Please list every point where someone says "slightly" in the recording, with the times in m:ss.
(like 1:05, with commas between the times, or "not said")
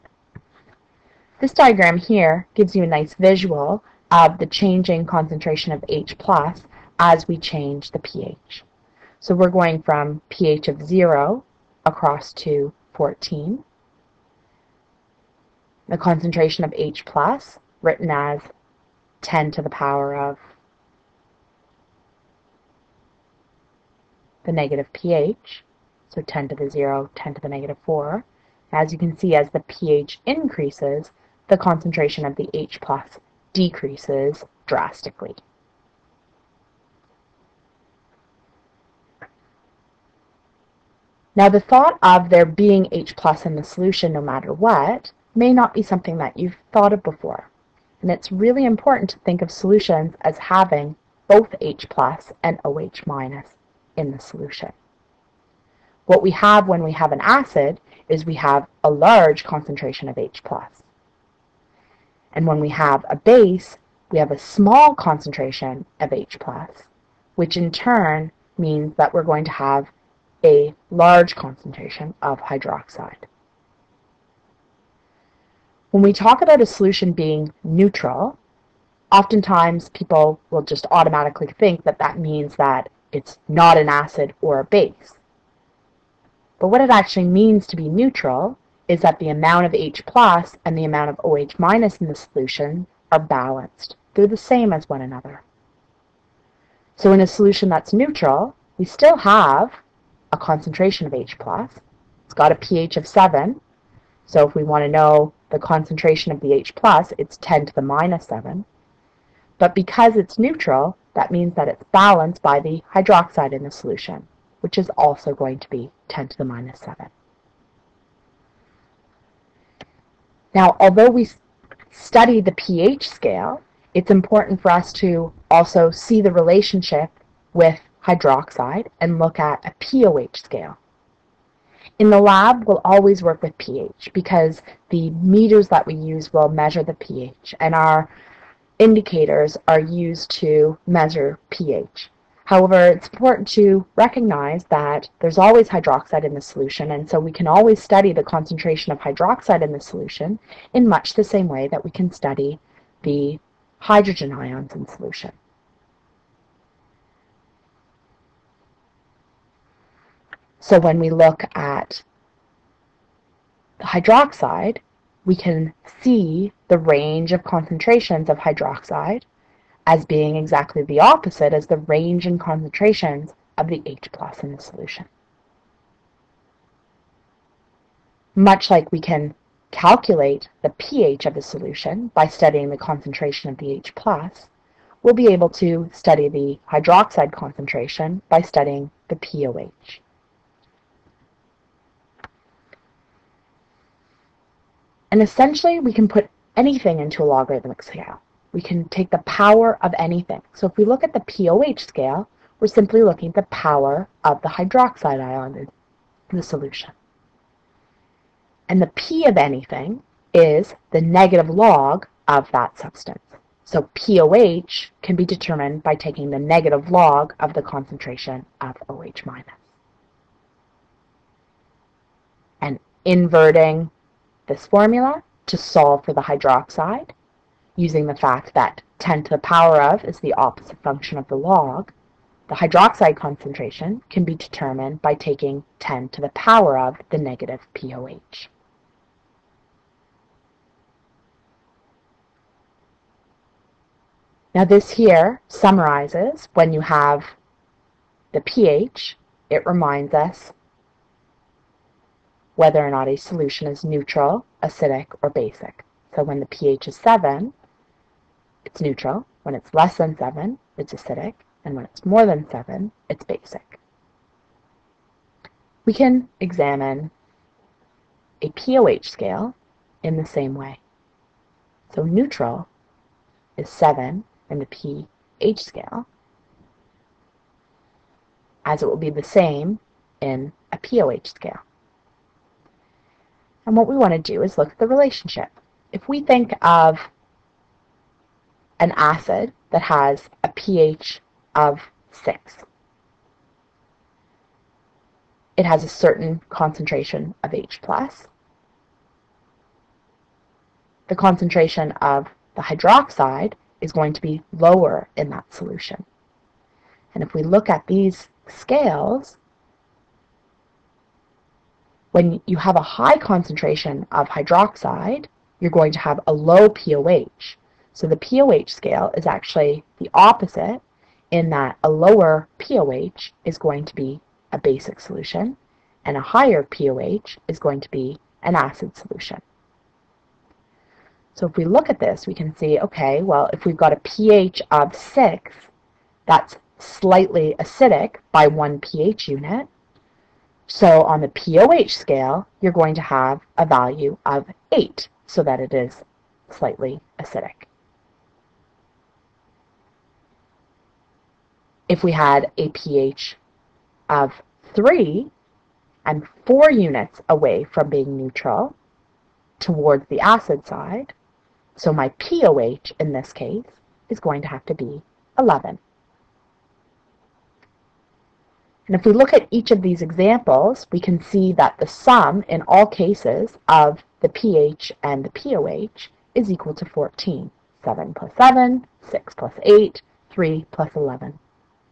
5:36, 5:46.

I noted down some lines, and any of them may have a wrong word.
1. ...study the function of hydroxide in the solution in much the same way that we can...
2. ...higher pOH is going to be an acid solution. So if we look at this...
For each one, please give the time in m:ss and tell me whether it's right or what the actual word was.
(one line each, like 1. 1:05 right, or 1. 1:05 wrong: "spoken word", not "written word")
1. 2:27 wrong: "concentration", not "function"
2. 5:26 right.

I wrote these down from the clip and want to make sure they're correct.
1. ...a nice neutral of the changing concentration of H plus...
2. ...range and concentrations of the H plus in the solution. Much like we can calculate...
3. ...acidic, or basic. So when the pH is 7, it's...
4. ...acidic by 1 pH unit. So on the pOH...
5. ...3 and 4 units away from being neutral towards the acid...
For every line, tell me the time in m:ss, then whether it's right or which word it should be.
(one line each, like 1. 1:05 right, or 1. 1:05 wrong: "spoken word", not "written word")
1. 0:02 wrong: "visual", not "neutral"
2. 2:51 right
3. 4:14 right
4. 5:37 right
5. 5:54 right.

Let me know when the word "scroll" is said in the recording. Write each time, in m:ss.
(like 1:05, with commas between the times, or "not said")
not said.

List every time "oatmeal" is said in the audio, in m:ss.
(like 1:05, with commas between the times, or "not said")
not said.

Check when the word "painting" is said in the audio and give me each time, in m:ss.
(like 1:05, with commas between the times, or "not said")
not said.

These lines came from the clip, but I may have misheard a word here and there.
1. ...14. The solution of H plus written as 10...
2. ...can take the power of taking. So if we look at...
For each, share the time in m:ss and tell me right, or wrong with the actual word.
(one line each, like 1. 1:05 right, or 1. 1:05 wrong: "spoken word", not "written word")
1. 0:12 wrong: "concentration", not "solution"
2. 3:18 wrong: "anything", not "taking".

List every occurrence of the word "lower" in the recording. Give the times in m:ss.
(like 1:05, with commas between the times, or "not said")
5:04, 5:21.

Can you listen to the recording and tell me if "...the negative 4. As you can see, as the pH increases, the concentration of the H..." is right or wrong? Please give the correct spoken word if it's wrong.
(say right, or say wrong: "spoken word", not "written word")
right.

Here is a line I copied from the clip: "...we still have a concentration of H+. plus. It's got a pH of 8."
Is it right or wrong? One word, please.
wrong.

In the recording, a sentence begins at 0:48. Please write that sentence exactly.
And it's really important to think of solutions as having both H plus and OH minus in the solution.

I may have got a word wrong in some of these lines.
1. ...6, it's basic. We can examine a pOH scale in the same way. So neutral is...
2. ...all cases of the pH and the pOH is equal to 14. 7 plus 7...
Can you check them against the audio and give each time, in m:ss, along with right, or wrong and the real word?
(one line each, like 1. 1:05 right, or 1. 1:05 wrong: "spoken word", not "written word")
1. 4:22 wrong: "7", not "6"
2. 6:12 right.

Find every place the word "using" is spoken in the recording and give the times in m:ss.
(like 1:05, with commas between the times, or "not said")
3:47.